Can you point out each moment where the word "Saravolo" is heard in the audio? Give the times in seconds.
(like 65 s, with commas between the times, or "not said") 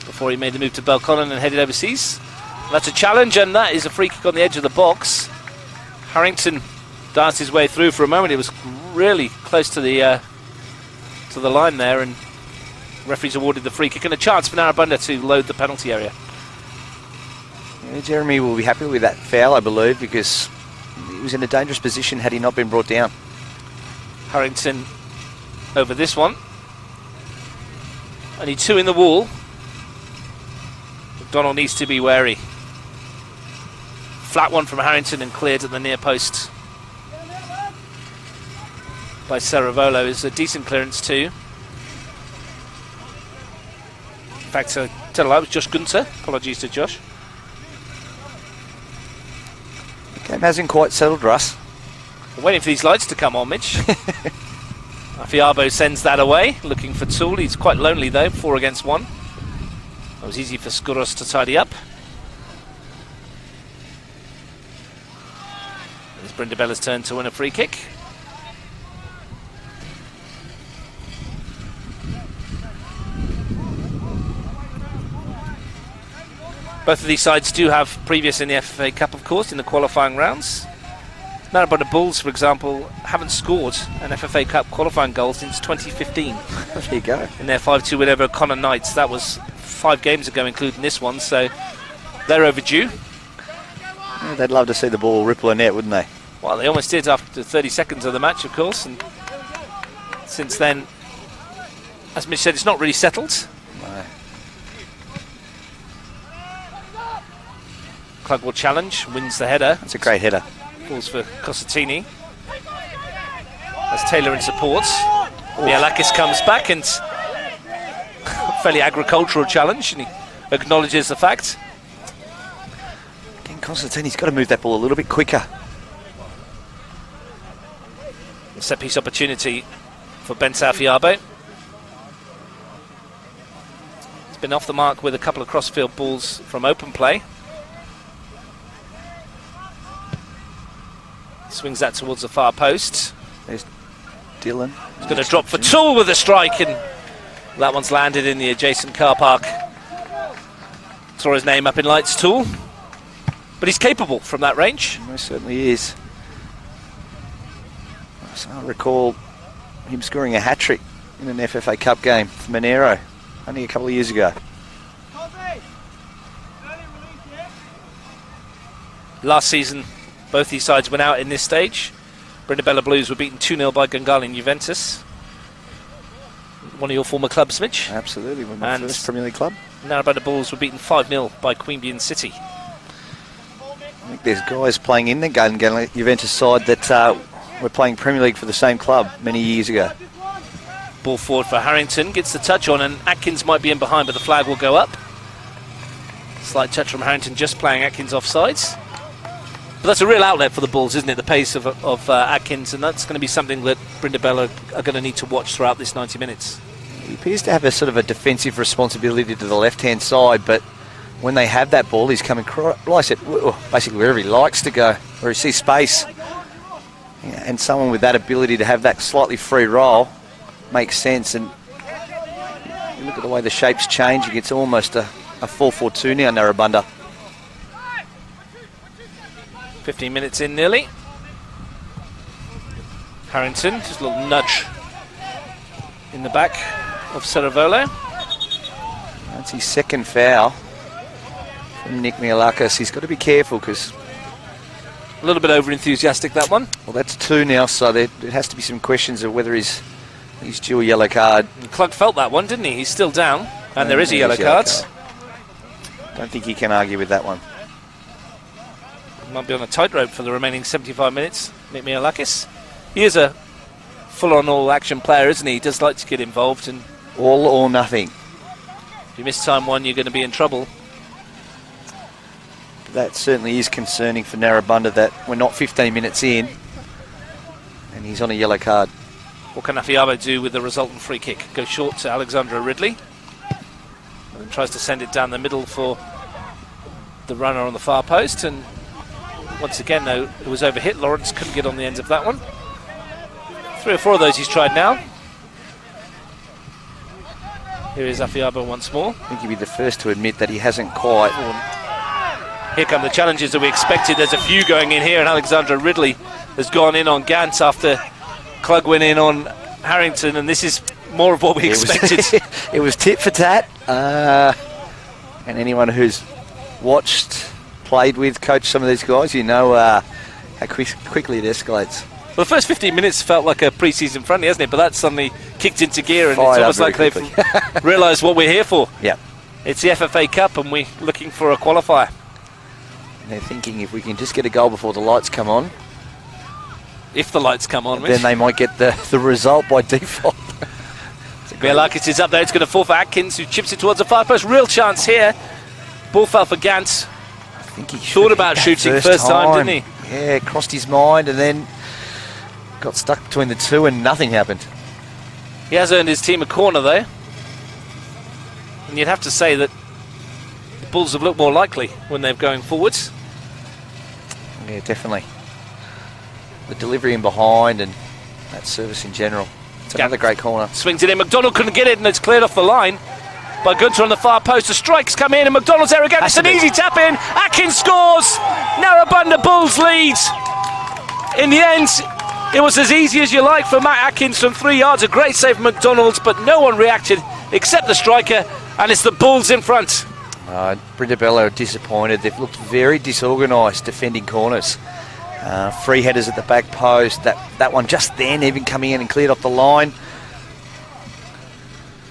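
39 s, 237 s.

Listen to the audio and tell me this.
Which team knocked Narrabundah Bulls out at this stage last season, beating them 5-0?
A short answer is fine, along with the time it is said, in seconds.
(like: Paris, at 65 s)
Queanbeyan City, at 181 s.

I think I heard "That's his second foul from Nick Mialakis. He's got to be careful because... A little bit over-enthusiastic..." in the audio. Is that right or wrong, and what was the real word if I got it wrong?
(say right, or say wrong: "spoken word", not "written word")
right.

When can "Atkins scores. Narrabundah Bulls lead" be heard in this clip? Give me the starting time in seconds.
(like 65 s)
377 s.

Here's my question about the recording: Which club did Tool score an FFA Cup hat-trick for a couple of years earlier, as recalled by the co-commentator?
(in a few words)
Monaro.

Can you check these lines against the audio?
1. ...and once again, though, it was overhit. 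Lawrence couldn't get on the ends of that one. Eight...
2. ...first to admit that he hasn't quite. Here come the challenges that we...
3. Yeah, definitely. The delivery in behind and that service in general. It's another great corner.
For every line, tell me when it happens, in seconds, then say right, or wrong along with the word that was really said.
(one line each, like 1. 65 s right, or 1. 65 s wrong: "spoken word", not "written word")
1. 288 s wrong: "Three", not "Eight"
2. 299 s right
3. 364 s right.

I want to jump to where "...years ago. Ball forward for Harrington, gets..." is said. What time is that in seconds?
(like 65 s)
189 s.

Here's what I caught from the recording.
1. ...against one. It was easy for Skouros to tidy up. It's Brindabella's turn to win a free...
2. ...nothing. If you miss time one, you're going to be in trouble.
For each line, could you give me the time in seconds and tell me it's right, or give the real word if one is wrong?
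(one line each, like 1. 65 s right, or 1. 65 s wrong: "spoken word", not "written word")
1. 58 s right
2. 267 s right.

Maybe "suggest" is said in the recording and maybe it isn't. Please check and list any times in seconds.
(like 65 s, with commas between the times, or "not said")
not said.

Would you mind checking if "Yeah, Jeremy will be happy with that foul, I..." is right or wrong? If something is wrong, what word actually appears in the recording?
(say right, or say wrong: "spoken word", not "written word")
right.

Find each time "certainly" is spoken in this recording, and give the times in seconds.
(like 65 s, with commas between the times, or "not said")
155 s, 273 s.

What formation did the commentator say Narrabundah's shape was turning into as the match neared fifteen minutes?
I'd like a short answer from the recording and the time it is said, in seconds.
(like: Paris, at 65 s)
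4-4-2, at 225 s.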